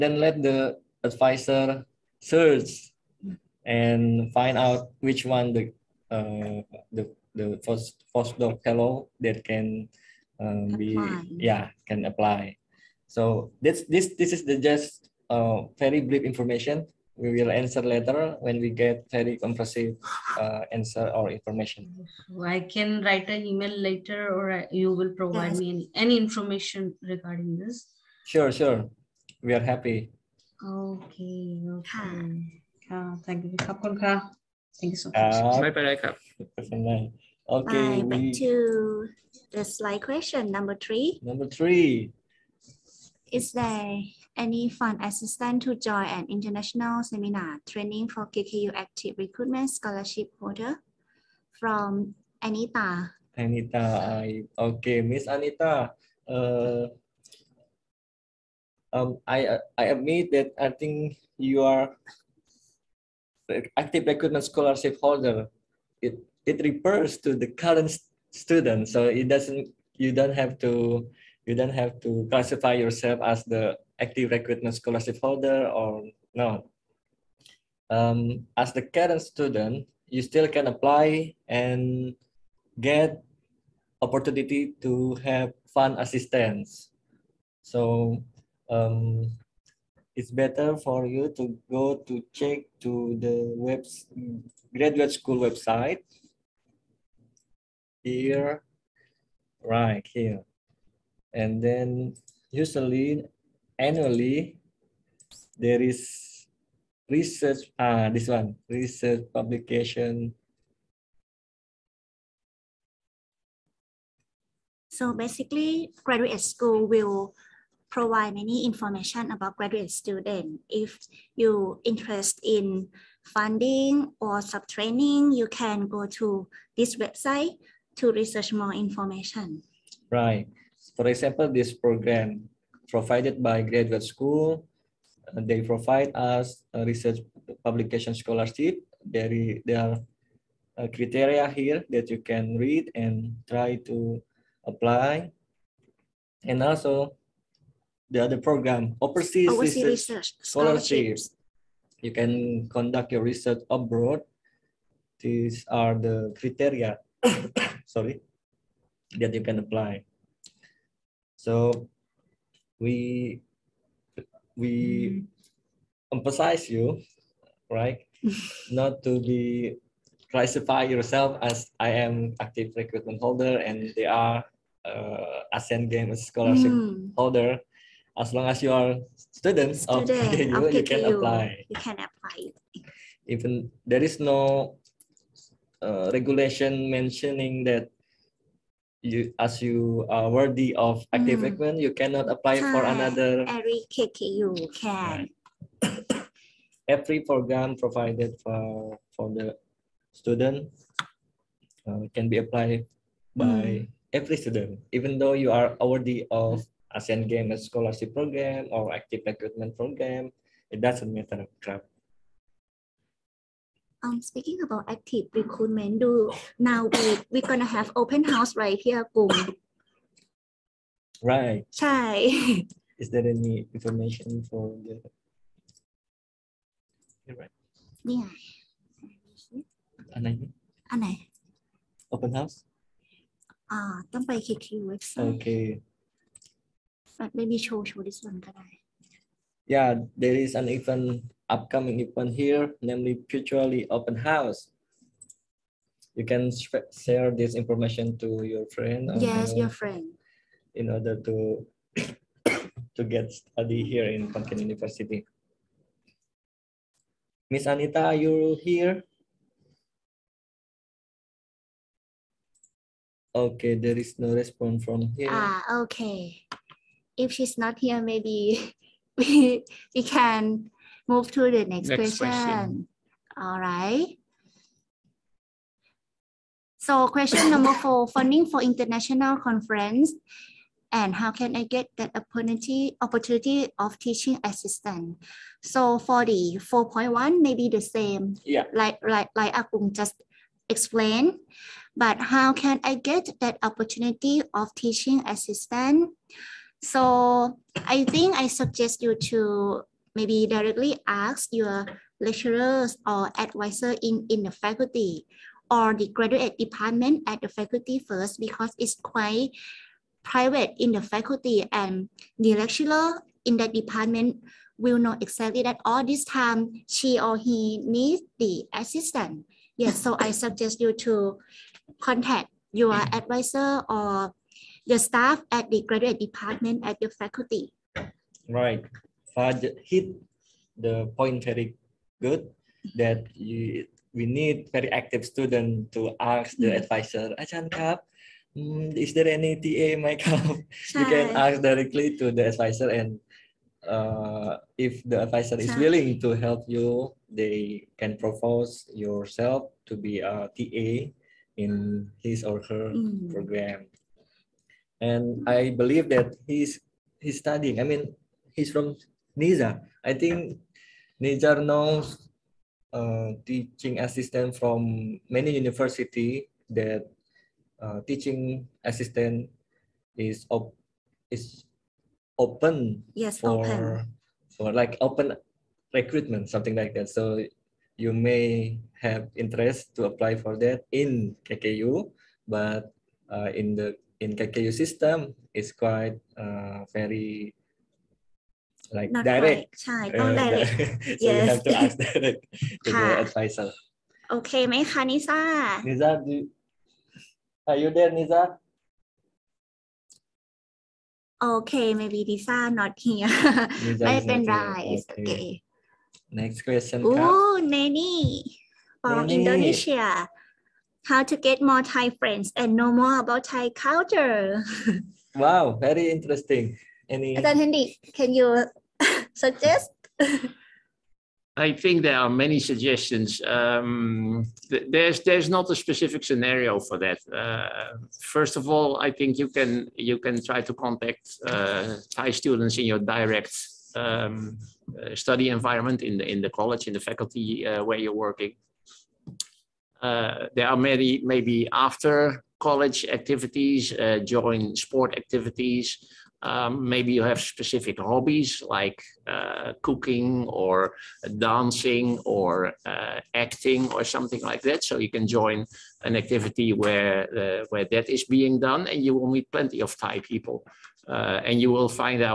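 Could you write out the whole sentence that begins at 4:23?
Okay, there is no response from here.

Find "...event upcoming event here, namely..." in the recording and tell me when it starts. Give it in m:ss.
4:00.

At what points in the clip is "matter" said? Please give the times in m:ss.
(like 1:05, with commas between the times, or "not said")
3:31.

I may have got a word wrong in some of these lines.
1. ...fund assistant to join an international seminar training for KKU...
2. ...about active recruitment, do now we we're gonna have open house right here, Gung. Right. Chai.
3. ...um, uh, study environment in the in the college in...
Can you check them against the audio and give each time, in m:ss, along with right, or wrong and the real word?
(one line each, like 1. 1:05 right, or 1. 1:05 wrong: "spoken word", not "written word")
1. 0:44 right
2. 3:34 right
3. 7:13 right.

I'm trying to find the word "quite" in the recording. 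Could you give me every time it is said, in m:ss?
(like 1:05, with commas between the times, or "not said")
5:08, 6:25.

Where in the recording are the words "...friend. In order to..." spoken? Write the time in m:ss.
4:09.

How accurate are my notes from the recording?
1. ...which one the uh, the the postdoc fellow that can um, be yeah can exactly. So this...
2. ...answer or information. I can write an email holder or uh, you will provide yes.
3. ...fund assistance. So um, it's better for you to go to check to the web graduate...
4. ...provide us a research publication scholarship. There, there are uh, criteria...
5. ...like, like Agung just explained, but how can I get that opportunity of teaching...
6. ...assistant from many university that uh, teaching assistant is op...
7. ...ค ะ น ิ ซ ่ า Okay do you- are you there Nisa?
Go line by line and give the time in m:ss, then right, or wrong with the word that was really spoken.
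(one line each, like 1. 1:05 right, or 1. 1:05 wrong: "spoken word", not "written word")
1. 0:05 wrong: "apply", not "exactly"
2. 0:20 wrong: "later", not "holder"
3. 1:25 right
4. 2:15 right
5. 4:49 right
6. 6:04 right
7. 6:34 wrong: "Niza", not "Okay".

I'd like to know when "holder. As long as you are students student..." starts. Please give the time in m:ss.
2:57.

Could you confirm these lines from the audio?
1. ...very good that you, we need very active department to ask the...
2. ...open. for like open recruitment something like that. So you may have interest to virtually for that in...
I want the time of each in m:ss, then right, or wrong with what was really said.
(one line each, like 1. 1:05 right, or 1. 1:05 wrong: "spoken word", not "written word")
1. 5:31 wrong: "student", not "department"
2. 6:13 wrong: "apply", not "virtually".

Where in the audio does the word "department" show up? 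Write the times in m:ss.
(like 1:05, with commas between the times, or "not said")
5:06, 5:13, 5:26.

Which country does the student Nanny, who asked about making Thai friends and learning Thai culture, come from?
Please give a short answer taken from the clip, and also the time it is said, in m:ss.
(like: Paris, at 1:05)
Indonesia, at 6:49.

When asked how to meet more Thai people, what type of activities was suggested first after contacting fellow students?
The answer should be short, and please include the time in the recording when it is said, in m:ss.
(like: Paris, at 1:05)
Sport activities, at 7:24.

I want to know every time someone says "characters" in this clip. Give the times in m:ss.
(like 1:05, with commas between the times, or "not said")
not said.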